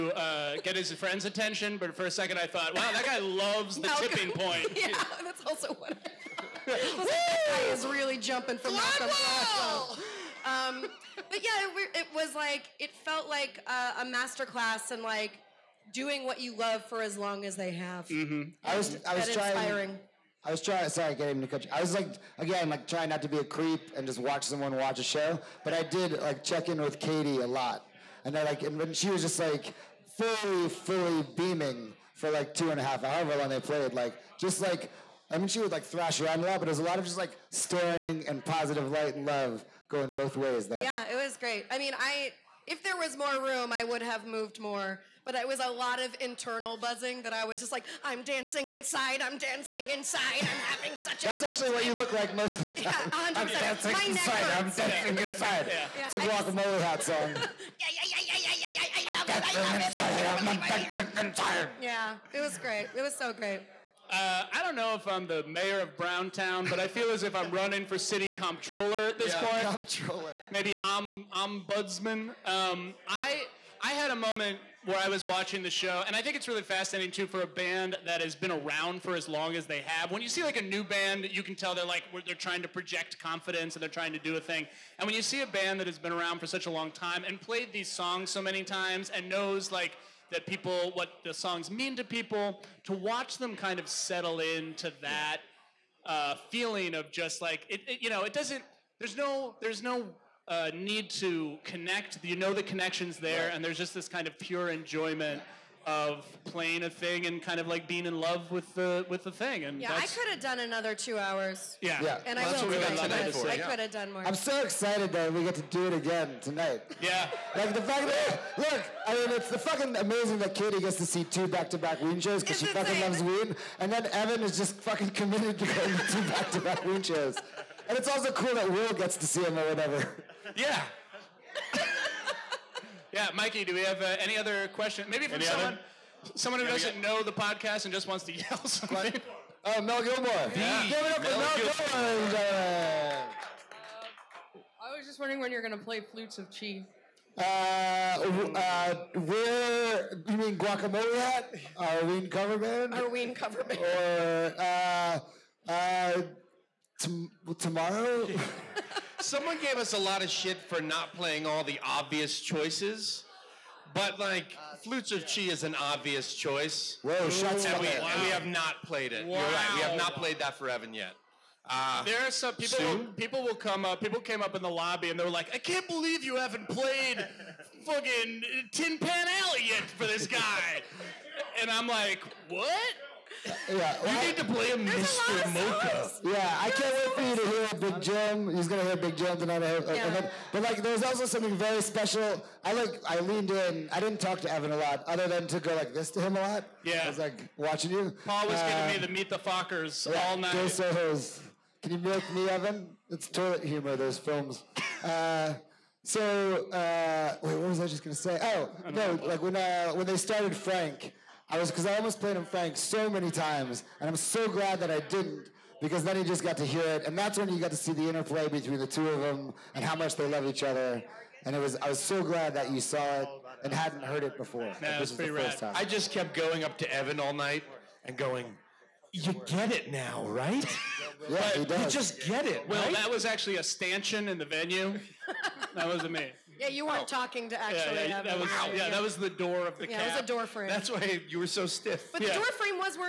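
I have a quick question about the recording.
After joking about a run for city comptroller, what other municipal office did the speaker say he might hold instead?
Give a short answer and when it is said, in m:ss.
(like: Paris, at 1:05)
Ombudsman, at 1:11.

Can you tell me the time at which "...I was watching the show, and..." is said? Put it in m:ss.
1:14.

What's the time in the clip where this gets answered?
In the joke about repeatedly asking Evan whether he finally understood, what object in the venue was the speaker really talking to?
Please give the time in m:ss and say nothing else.
3:53.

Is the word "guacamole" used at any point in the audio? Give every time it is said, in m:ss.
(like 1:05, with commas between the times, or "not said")
0:56, 2:30.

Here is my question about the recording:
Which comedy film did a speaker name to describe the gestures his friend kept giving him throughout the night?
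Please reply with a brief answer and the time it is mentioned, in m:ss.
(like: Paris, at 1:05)
Meet the Fockers, at 3:19.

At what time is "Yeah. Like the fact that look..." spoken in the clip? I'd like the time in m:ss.
1:57.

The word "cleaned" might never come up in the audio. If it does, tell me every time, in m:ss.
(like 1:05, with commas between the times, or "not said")
not said.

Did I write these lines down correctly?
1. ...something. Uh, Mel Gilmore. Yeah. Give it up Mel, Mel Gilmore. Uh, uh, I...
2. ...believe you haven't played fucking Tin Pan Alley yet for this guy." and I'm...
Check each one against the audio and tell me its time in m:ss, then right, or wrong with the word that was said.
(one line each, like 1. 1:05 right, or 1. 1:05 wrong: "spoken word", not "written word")
1. 2:18 right
2. 2:55 right.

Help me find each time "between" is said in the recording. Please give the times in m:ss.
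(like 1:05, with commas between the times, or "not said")
3:38.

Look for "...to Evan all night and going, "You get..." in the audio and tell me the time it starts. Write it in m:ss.
3:46.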